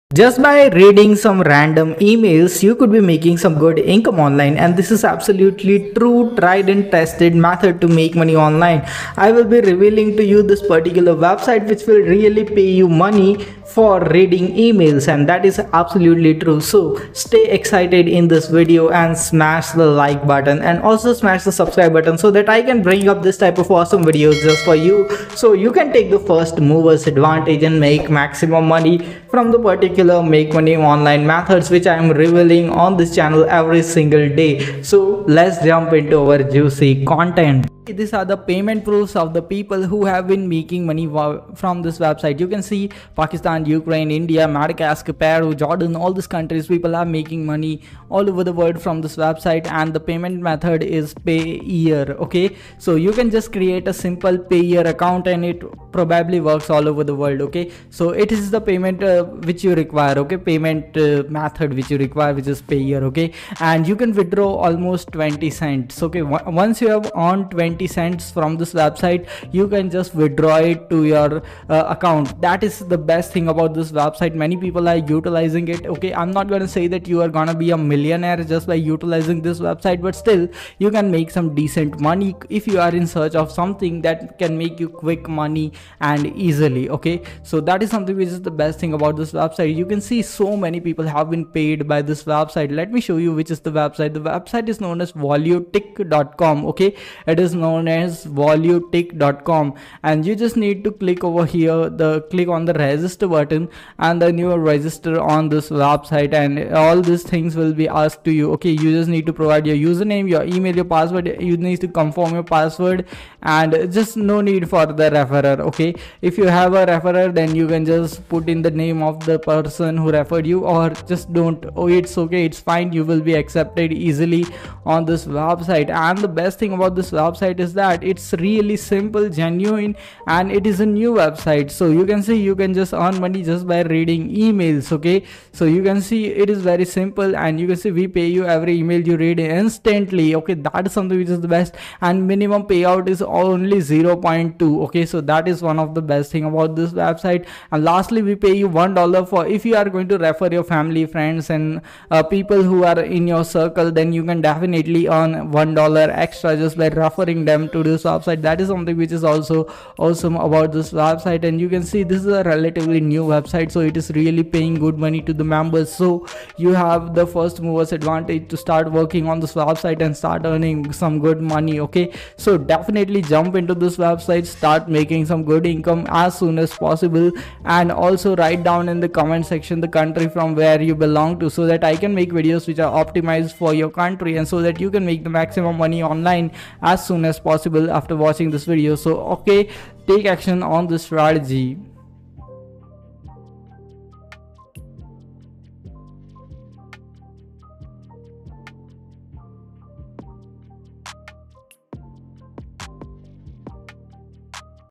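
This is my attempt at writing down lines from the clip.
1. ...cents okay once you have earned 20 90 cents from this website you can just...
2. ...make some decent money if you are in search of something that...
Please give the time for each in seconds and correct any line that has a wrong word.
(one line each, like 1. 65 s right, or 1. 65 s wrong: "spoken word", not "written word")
1. 65 s right
2. 81 s right.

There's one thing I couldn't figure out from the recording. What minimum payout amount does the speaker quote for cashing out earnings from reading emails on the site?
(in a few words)
0.2.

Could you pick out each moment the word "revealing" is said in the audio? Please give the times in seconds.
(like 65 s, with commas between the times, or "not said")
9 s, 32 s.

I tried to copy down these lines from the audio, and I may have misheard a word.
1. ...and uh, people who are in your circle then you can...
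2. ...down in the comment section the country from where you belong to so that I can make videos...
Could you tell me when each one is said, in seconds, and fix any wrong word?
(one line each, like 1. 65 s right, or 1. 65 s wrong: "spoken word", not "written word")
1. 151 s right
2. 178 s right.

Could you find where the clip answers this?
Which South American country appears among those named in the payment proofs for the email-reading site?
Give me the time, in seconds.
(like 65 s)
45 s.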